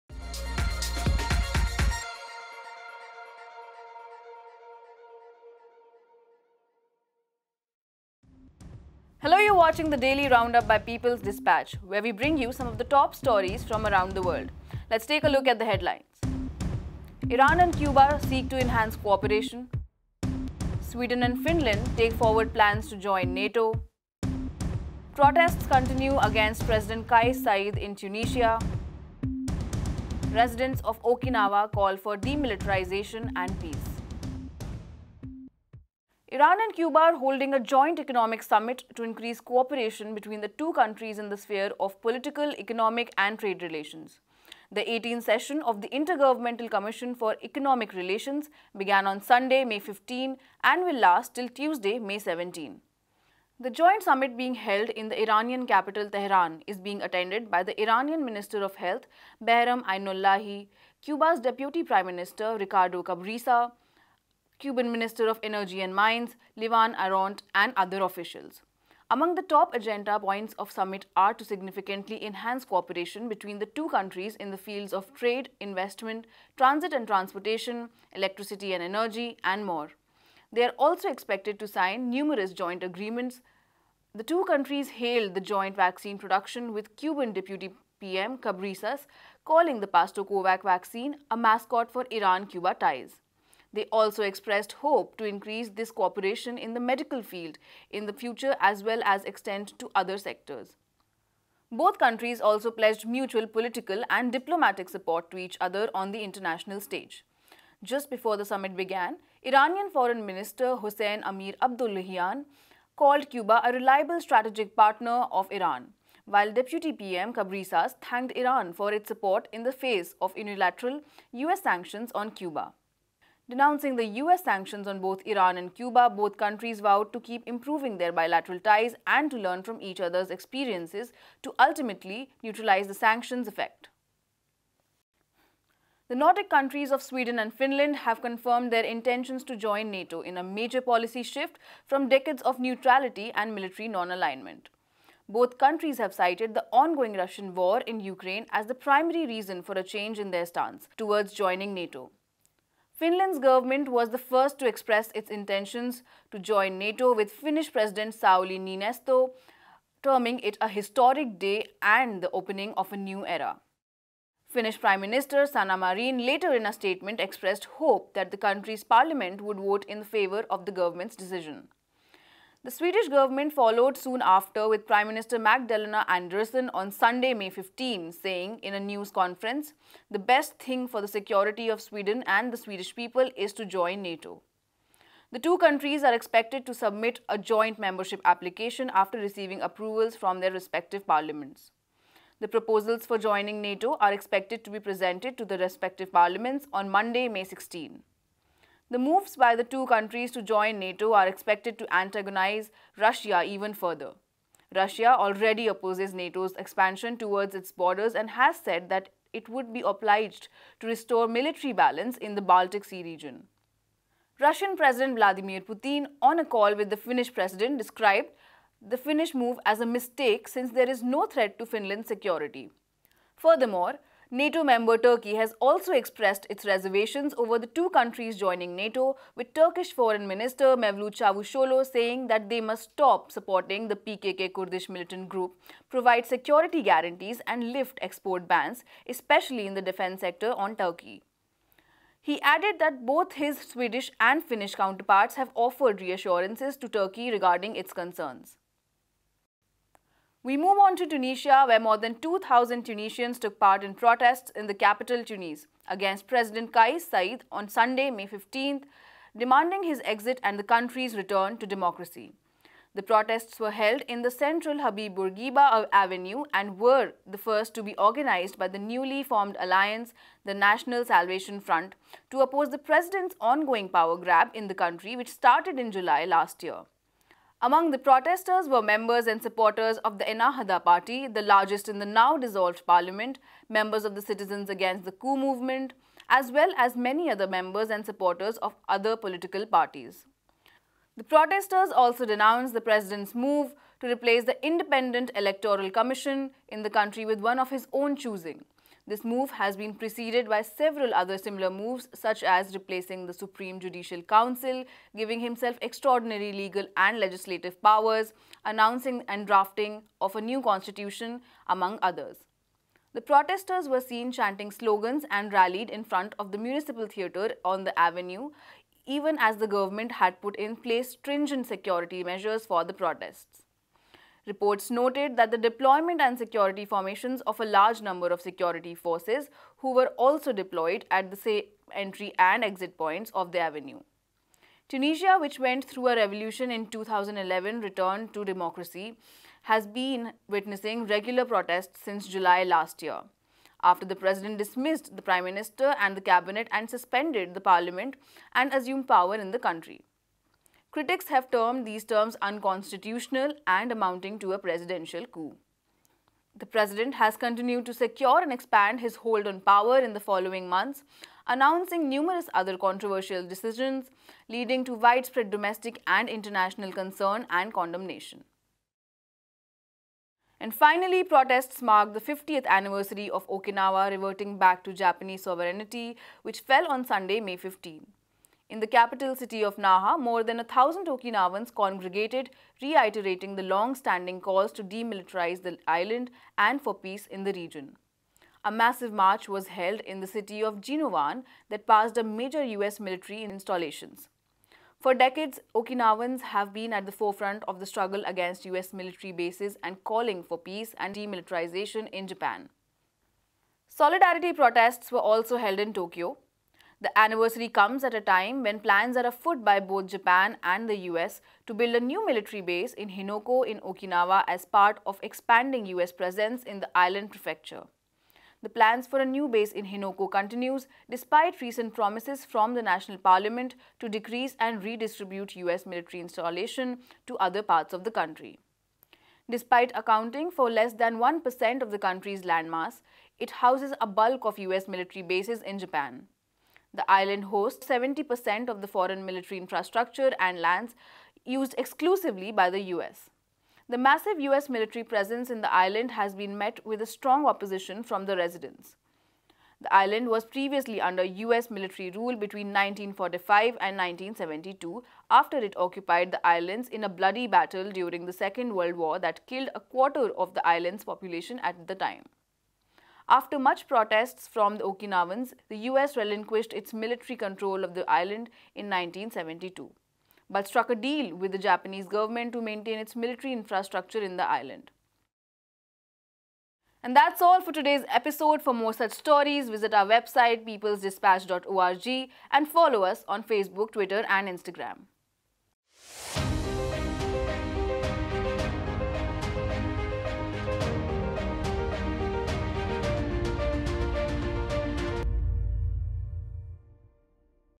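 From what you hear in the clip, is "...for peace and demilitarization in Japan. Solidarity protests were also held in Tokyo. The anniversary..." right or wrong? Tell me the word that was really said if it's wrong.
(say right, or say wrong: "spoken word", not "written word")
right.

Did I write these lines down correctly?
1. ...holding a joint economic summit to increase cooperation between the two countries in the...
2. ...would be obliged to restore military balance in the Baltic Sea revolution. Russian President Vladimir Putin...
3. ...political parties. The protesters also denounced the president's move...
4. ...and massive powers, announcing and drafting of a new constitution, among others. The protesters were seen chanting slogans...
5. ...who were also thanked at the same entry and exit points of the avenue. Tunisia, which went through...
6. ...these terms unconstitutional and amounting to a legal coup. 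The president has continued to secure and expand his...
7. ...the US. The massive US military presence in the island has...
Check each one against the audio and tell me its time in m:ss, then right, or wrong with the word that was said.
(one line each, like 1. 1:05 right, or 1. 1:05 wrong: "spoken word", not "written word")
1. 0:37 right
2. 3:29 wrong: "region", not "revolution"
3. 4:49 right
4. 5:06 wrong: "legislative", not "massive"
5. 5:29 wrong: "deployed", not "thanked"
6. 5:51 wrong: "presidential", not "legal"
7. 7:22 right.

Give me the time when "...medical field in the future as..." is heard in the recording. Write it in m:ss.
1:36.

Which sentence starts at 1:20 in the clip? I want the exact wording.
They are also expected to sign numerous joint agreements.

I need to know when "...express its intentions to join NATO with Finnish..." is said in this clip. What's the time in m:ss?
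2:34.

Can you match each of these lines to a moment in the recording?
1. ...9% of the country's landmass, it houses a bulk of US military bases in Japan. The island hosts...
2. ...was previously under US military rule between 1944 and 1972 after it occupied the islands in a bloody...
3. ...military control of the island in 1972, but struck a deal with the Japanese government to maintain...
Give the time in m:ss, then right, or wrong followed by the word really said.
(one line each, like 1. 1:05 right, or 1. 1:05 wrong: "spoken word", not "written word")
1. 7:11 wrong: "1", not "9"
2. 7:30 wrong: "1945", not "1944"
3. 7:46 right.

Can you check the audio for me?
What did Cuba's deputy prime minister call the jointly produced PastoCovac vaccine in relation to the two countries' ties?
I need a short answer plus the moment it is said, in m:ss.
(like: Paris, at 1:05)
a mascot, at 1:31.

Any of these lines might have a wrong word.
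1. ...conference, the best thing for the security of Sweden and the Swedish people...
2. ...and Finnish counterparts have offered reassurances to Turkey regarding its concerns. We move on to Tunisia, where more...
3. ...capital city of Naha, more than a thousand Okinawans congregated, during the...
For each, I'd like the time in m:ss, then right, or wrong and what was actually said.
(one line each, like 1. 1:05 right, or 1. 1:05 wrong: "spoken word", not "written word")
1. 2:59 right
2. 4:04 right
3. 6:18 wrong: "reiterating", not "during".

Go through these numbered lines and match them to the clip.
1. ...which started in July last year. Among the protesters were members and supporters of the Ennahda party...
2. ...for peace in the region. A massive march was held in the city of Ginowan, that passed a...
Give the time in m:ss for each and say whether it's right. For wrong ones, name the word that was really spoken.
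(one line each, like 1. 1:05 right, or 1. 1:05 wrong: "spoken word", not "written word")
1. 4:35 right
2. 6:26 right.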